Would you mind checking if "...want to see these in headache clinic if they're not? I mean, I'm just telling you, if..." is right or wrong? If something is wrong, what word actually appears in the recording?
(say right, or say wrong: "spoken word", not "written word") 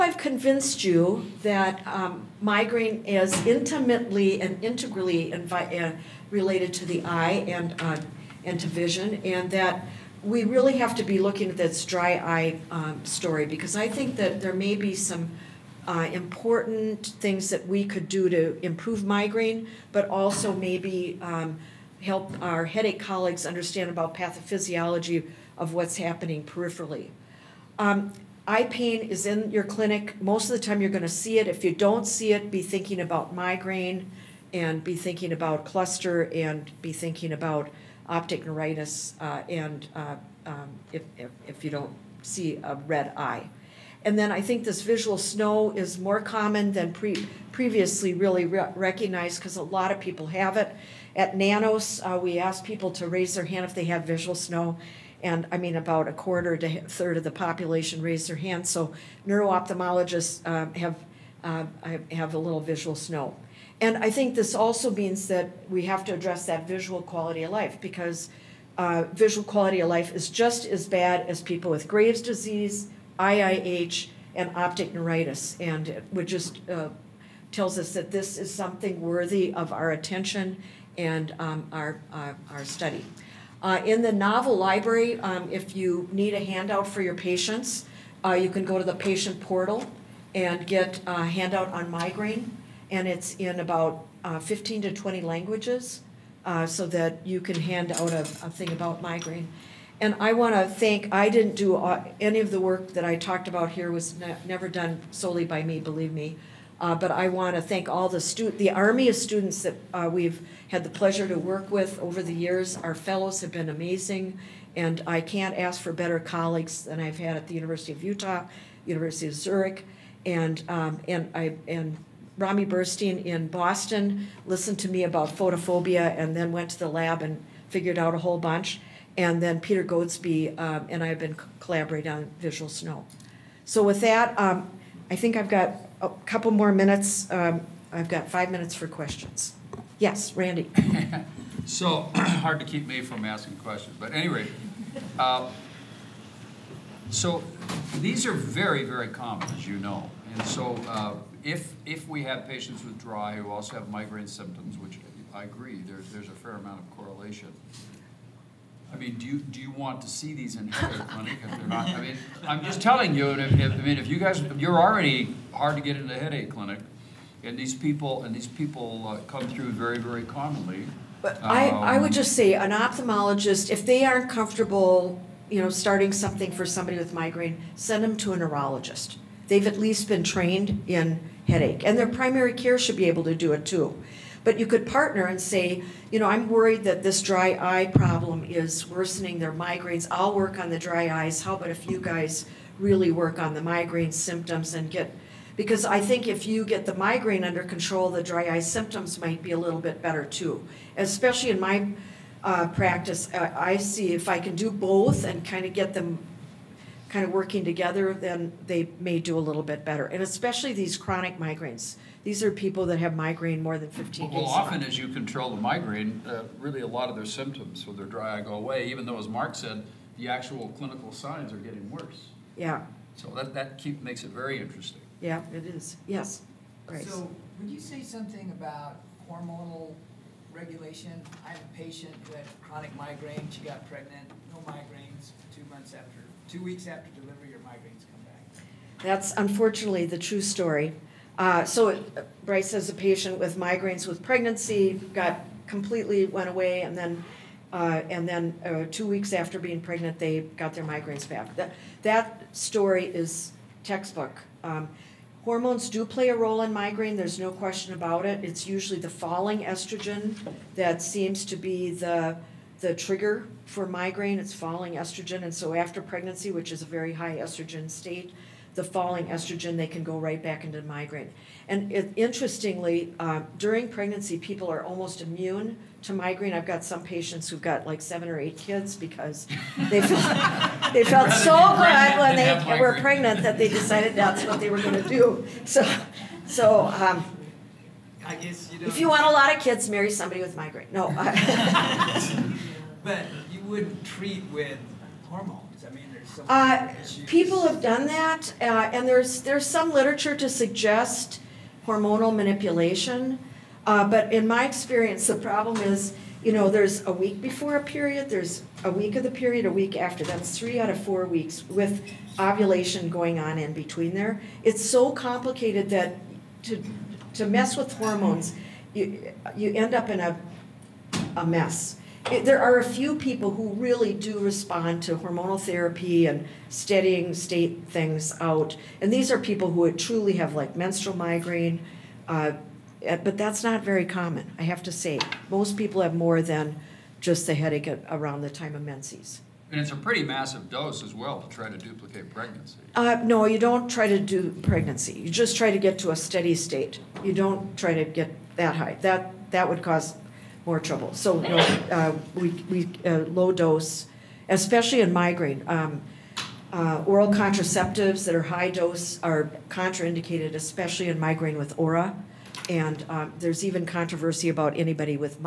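right.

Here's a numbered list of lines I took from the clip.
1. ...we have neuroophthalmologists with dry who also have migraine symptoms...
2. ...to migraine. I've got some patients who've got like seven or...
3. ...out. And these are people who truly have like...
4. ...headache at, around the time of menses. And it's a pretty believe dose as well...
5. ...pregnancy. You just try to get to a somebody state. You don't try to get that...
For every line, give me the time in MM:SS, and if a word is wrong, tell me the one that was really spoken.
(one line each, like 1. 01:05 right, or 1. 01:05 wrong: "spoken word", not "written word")
1. 02:32 wrong: "patients", not "neuroophthalmologists"
2. 04:36 right
3. 05:28 right
4. 05:37 wrong: "massive", not "believe"
5. 05:44 wrong: "steady", not "somebody".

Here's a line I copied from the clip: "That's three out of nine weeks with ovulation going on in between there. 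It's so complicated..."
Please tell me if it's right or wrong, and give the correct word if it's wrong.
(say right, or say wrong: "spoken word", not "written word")
wrong: "four", not "nine".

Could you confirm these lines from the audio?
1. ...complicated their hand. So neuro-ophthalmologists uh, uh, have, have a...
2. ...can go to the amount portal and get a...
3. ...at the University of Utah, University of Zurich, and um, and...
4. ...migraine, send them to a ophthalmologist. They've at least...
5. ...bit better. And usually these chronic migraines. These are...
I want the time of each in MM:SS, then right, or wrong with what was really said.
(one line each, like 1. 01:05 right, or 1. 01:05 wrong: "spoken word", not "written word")
1. 00:58 wrong: "raised", not "complicated"
2. 01:28 wrong: "patient", not "amount"
3. 01:57 right
4. 02:57 wrong: "neurologist", not "ophthalmologist"
5. 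03:29 wrong: "especially", not "usually".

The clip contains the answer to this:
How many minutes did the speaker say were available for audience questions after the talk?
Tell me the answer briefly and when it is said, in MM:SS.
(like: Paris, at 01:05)
5, at 02:18.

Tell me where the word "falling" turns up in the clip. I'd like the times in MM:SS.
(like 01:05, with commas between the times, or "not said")
04:19, 04:24, 04:28.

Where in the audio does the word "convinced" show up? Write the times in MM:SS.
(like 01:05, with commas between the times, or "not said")
00:00.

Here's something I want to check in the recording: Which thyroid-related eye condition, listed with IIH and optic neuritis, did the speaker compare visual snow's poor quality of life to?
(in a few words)
Graves' disease.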